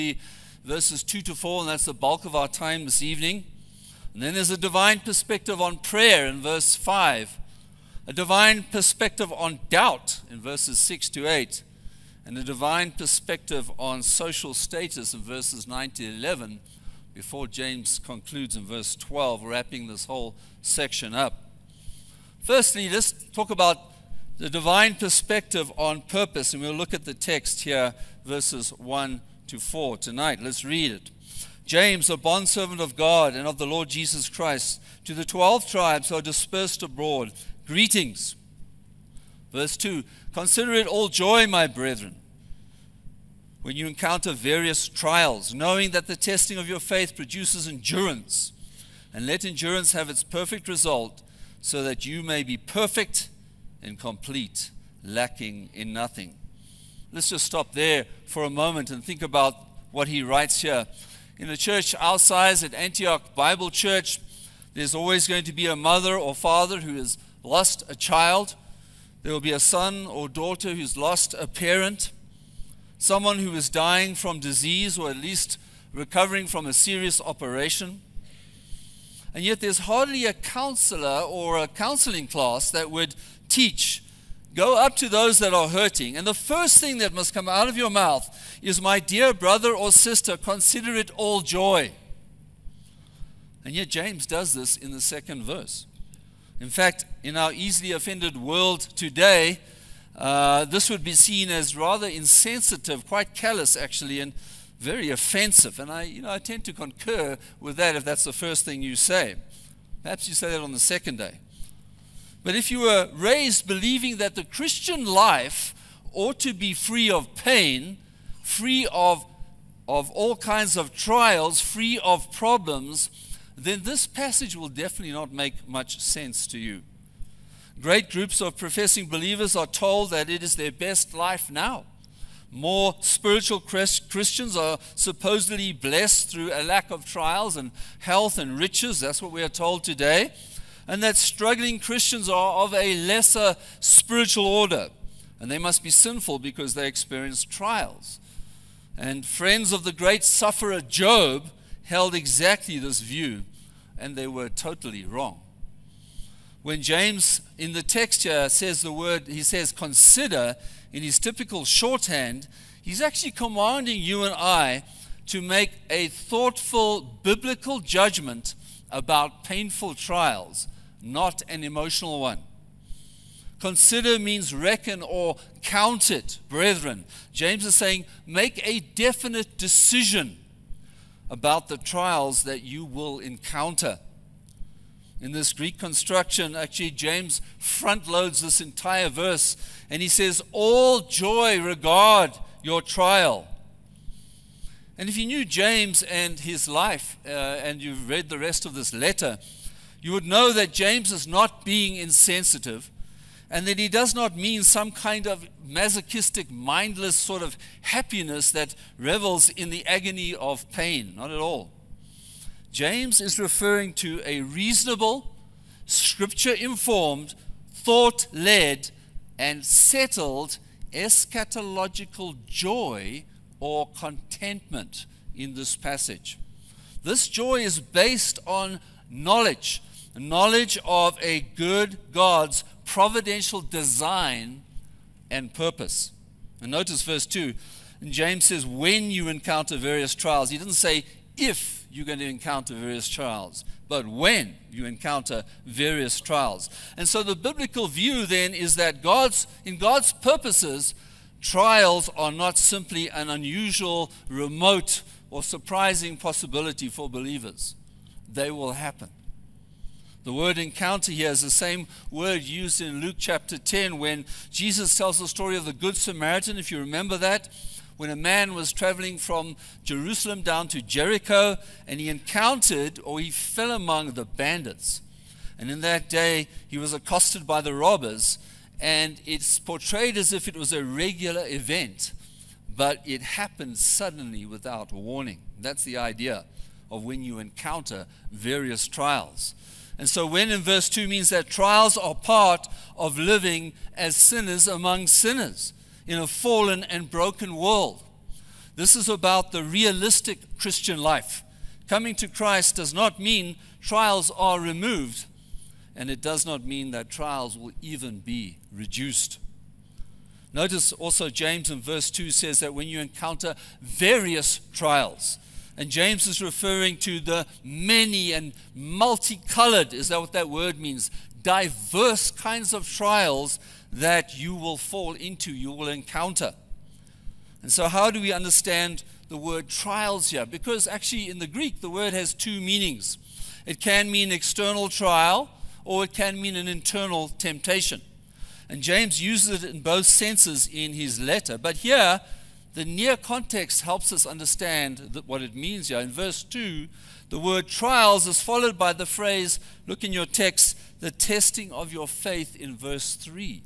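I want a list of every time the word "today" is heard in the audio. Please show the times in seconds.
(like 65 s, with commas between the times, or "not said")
98 s, 139 s.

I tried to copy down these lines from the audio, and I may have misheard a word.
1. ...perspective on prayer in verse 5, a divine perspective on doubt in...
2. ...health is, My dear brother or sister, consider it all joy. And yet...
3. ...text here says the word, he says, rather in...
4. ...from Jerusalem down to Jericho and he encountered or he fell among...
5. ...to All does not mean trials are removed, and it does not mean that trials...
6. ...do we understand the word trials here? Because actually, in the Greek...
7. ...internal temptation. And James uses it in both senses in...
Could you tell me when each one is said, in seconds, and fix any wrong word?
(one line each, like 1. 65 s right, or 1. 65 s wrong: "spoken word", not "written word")
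1. 4 s right
2. 87 s wrong: "mouth", not "health"
3. 157 s wrong: "consider", not "rather"
4. 269 s right
5. 302 s wrong: "Christ", not "All"
6. 328 s right
7. 336 s right.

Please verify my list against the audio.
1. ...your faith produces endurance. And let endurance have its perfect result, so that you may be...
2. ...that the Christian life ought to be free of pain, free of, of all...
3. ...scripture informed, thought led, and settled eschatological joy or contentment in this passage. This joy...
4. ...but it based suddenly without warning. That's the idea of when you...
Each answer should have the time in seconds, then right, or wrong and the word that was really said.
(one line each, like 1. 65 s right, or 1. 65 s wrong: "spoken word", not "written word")
1. 46 s right
2. 114 s right
3. 215 s right
4. 282 s wrong: "happened", not "based".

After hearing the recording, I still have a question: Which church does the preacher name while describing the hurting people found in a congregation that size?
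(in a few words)
Antioch Bible Church.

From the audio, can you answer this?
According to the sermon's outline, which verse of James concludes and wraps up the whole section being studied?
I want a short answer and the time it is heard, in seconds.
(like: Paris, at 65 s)
Verse 12, at 18 s.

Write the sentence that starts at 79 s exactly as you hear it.
And yet, there's hardly a counselor or a counseling class that would teach.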